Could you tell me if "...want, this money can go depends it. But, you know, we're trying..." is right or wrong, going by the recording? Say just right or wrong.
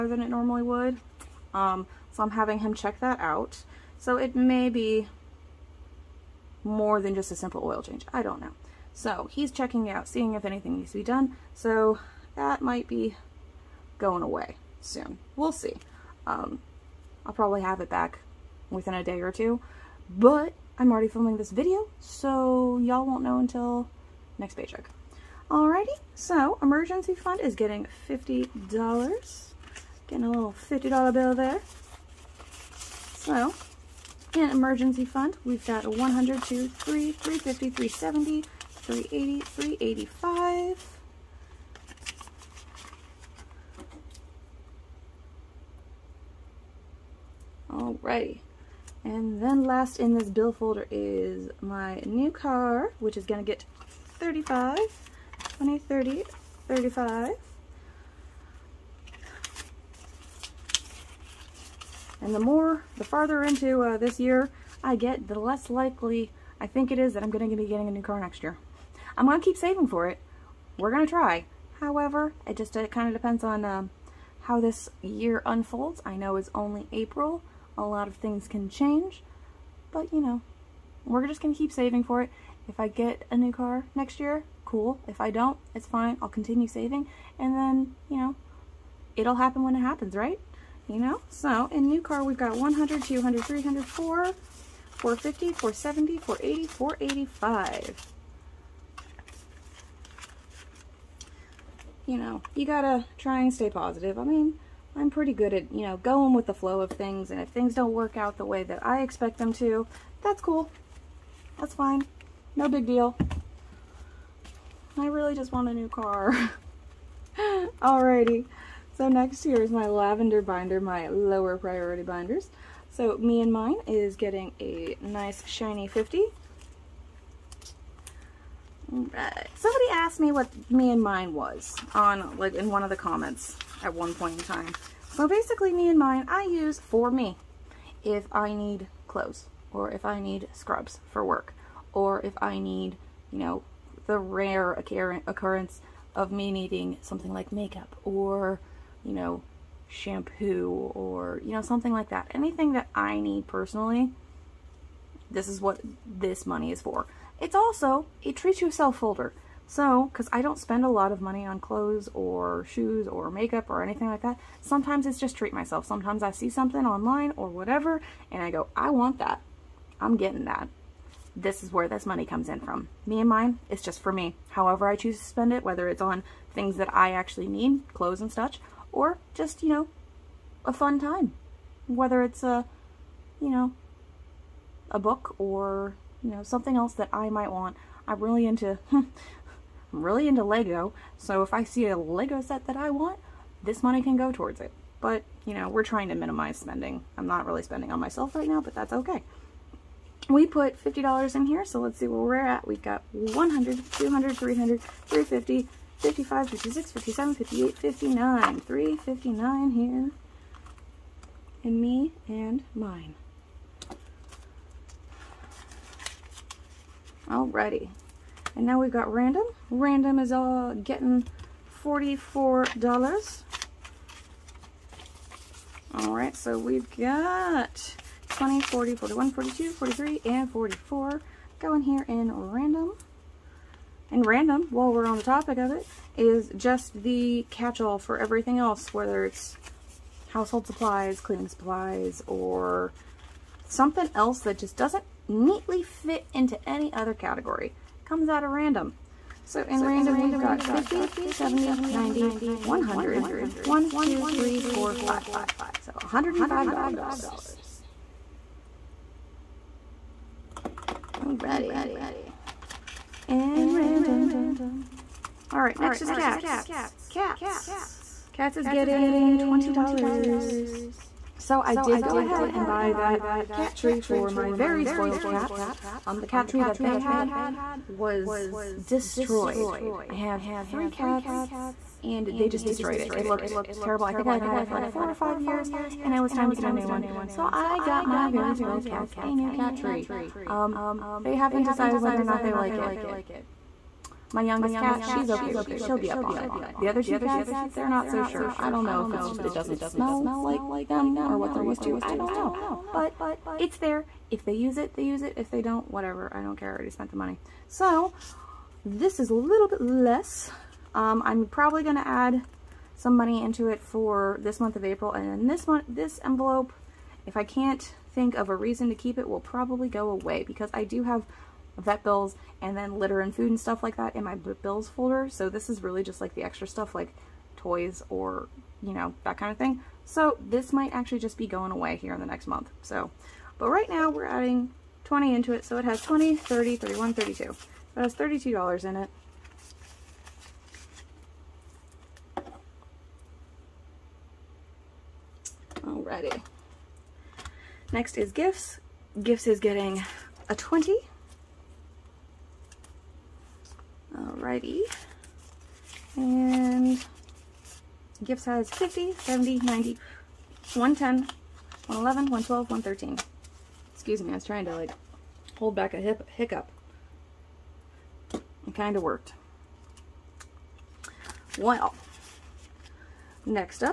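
wrong.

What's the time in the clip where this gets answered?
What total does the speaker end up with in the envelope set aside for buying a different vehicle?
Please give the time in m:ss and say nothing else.
1:36.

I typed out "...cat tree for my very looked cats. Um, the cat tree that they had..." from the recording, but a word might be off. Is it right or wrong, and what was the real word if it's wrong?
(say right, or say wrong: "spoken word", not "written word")
wrong: "spoiled", not "looked".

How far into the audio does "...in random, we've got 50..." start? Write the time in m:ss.
4:09.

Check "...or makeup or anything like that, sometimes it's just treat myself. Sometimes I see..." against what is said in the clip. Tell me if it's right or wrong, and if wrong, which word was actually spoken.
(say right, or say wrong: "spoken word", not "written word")
right.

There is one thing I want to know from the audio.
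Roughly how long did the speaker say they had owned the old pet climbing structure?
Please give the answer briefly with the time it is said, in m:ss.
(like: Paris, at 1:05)
4 or 5 years, at 4:44.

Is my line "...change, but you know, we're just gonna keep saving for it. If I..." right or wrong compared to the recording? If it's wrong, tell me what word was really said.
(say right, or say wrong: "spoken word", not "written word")
right.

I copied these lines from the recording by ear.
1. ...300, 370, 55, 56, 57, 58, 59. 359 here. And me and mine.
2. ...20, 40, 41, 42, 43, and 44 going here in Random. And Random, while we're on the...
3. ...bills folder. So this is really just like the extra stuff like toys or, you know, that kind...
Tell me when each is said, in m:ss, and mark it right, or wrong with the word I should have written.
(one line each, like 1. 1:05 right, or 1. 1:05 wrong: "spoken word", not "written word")
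1. 3:24 wrong: "350", not "370"
2. 3:48 right
3. 5:24 right.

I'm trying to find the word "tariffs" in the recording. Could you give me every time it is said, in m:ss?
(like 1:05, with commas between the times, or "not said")
not said.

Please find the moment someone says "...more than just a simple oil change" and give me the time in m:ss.
0:06.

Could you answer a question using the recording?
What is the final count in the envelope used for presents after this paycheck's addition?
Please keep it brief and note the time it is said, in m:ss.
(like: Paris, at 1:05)
$113, at 6:02.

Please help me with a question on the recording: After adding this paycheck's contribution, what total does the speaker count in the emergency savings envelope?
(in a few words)
$385.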